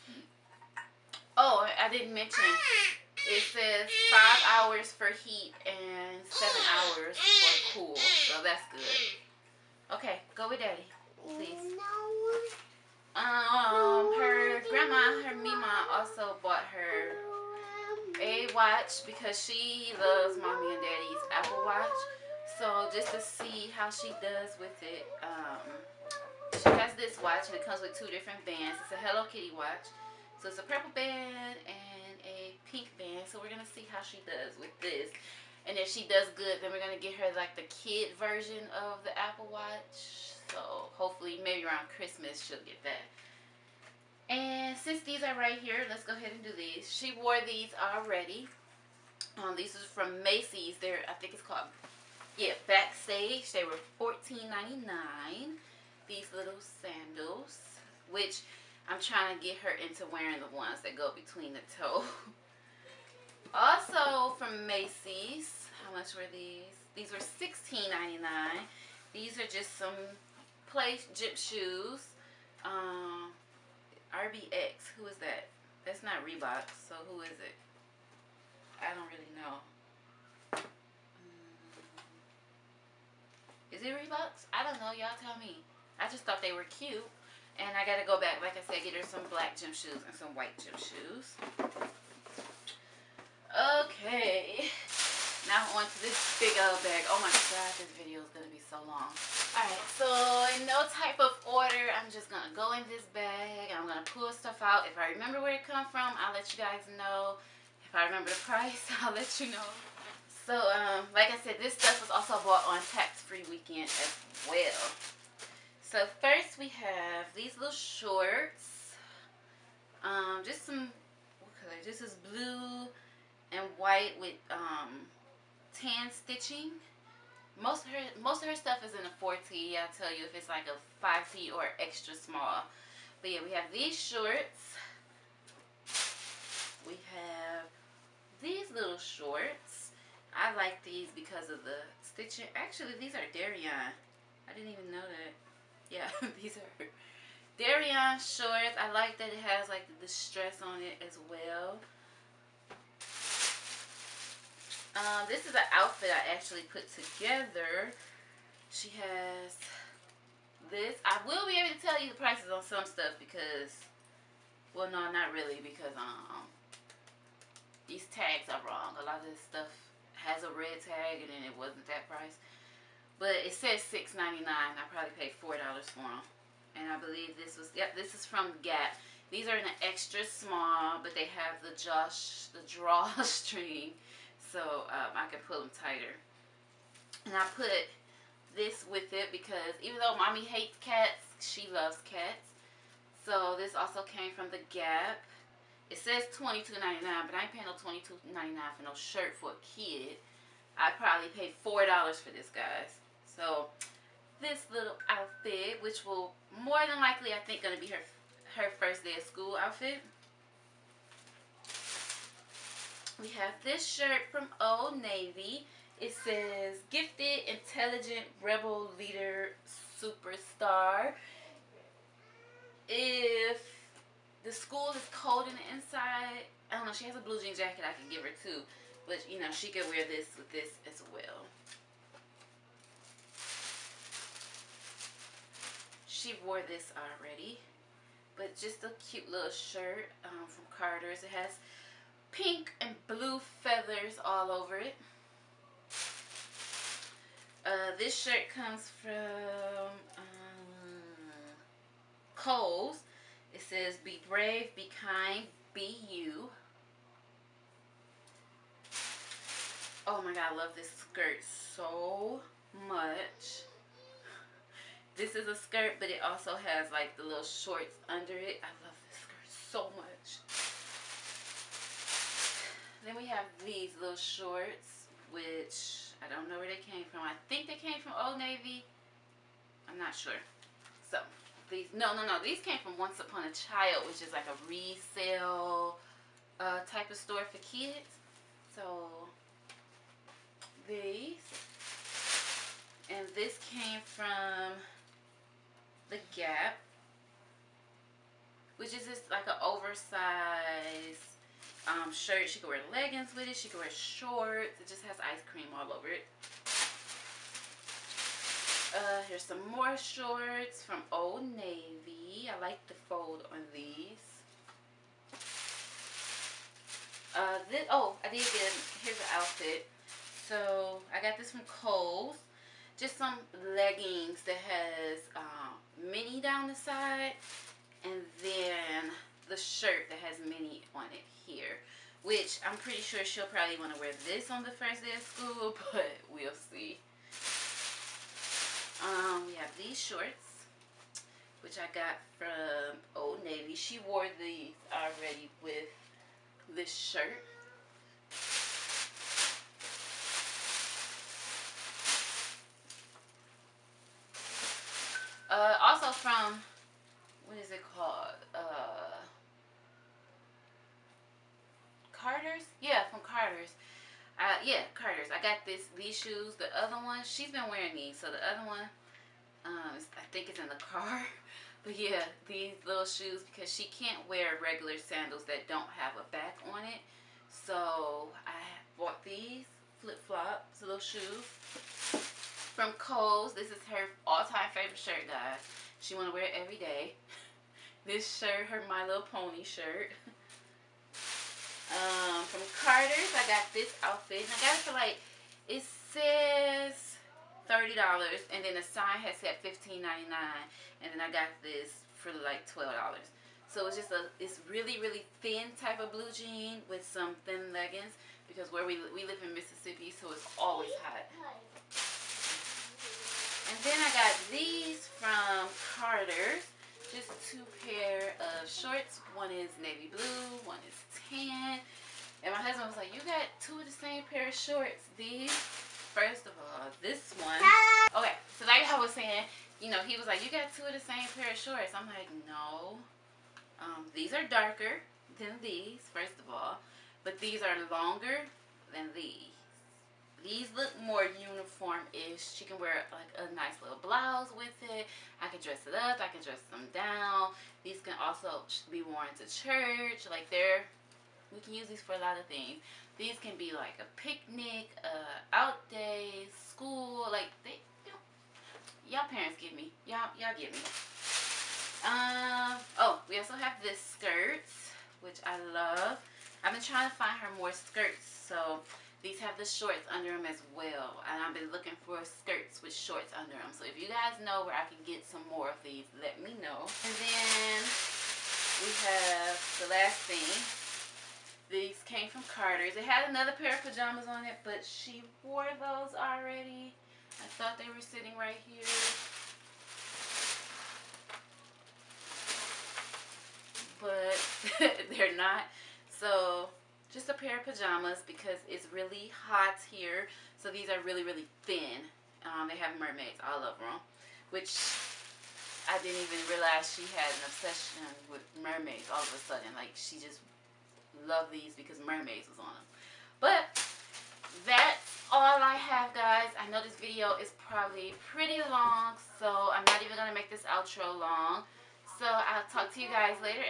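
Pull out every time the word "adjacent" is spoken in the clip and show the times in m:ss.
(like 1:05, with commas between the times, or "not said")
not said.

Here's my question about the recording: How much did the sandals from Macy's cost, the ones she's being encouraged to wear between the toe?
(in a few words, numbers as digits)
$16.99.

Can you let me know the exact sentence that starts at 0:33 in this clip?
So we're going to see how she does with this.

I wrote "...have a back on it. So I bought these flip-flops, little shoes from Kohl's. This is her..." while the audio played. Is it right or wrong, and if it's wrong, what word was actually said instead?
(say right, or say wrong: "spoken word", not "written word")
right.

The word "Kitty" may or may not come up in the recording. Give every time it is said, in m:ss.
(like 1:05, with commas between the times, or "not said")
0:29.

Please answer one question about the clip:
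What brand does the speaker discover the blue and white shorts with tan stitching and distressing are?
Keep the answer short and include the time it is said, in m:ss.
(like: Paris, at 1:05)
Darion, at 2:23.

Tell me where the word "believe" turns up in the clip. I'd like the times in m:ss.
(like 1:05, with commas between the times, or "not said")
2:56.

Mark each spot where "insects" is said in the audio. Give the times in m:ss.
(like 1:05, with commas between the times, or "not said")
not said.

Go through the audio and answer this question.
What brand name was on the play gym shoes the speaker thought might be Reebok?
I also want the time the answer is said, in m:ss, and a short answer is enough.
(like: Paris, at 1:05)
RBX, at 1:14.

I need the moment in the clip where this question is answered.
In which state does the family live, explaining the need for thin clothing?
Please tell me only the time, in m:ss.
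6:49.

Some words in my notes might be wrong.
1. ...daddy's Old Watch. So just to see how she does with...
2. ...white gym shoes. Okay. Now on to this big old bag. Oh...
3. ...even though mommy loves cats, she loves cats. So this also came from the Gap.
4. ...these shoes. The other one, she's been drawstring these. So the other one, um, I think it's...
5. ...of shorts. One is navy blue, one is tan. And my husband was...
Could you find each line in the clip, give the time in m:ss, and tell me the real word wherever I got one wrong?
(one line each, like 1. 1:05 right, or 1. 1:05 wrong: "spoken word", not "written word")
1. 0:20 wrong: "Apple", not "Old"
2. 1:30 right
3. 3:09 wrong: "hates", not "loves"
4. 6:05 wrong: "wearing", not "drawstring"
5. 6:58 right.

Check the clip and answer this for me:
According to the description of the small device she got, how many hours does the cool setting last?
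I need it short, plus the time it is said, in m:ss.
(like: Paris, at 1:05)
7 hours, at 0:06.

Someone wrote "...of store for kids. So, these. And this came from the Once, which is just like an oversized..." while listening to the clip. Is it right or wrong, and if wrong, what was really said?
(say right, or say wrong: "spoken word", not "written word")
wrong: "Gap", not "Once".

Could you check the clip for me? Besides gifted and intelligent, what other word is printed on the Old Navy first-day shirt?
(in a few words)
superstar.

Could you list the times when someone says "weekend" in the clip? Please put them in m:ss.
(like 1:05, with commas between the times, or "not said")
1:53.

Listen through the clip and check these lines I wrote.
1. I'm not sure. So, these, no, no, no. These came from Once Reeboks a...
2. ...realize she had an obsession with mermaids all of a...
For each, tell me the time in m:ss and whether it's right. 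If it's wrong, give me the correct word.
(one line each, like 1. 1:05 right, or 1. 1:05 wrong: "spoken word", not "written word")
1. 4:39 wrong: "Upon", not "Reeboks"
2. 8:26 right.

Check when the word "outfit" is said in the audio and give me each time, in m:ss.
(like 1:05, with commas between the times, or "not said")
2:35, 3:25, 3:29, 5:19, 6:34.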